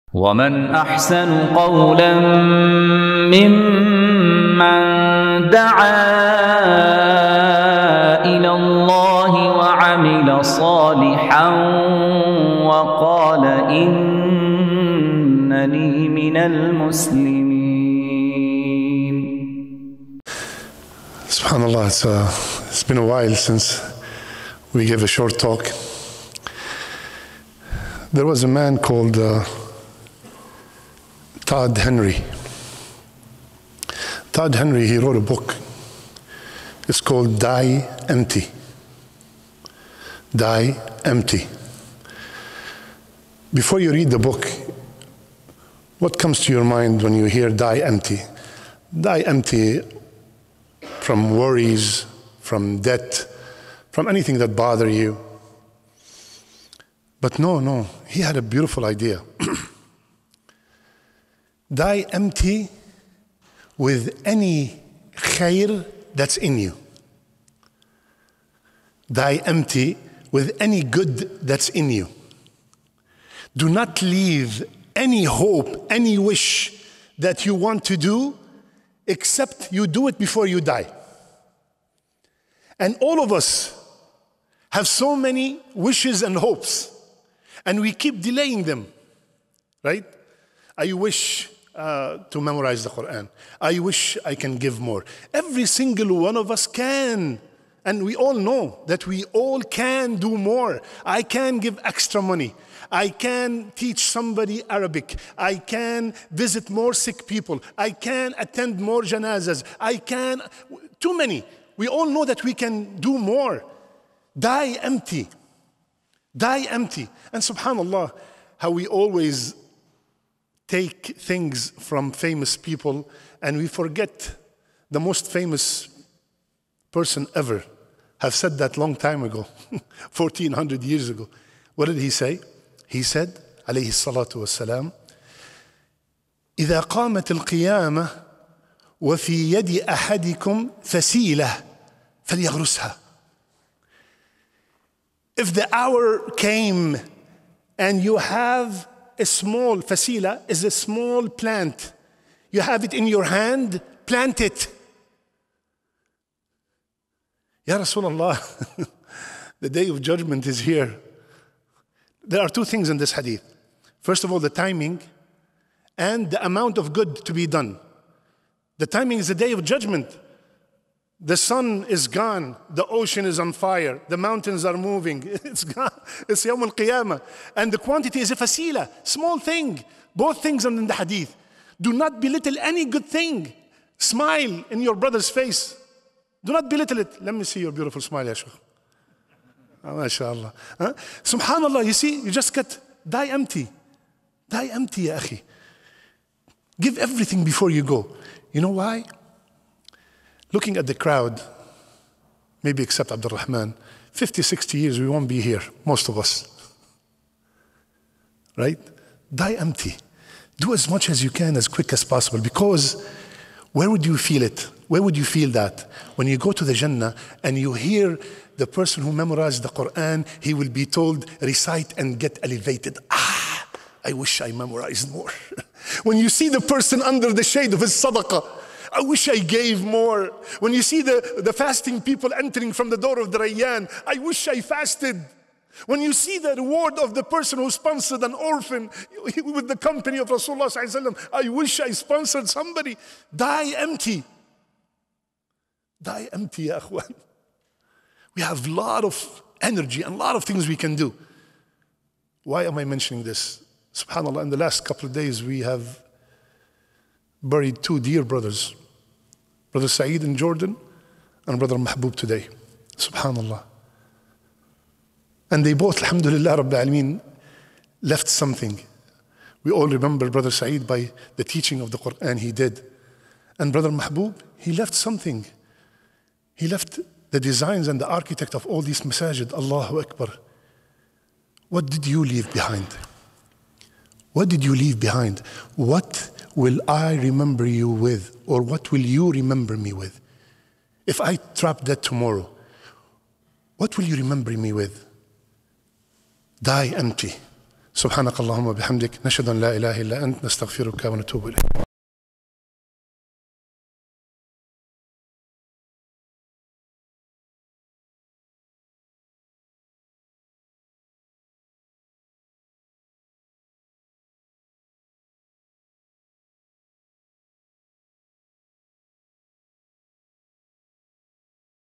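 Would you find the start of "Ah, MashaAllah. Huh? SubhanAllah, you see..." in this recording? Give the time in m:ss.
3:09.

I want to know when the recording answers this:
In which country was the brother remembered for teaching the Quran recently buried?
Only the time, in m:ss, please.
4:20.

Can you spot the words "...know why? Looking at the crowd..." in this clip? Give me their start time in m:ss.
3:18.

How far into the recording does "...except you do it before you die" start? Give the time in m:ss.
1:19.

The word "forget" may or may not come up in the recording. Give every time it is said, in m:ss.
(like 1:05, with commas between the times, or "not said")
2:03.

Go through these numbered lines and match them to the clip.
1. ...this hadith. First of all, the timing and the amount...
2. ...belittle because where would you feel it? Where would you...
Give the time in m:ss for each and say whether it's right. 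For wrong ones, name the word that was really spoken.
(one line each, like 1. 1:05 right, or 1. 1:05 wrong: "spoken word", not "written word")
1. 2:42 right
2. 3:32 wrong: "possible", not "belittle".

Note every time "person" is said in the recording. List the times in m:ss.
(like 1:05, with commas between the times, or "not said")
2:06, 3:38, 3:46, 3:57.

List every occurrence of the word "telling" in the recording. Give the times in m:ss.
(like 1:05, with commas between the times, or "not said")
not said.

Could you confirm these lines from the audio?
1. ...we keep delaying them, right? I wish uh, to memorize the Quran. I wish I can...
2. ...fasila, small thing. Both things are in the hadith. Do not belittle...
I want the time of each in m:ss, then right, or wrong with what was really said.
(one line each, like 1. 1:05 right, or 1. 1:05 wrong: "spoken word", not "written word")
1. 1:27 right
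2. 2:58 right.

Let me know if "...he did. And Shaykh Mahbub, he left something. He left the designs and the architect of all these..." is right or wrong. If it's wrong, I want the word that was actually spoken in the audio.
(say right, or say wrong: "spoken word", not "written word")
wrong: "Brother", not "Shaykh".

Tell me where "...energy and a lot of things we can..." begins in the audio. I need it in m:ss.
4:09.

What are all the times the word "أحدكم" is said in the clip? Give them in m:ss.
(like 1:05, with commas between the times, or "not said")
2:19.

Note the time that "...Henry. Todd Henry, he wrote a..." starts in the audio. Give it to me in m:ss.
0:31.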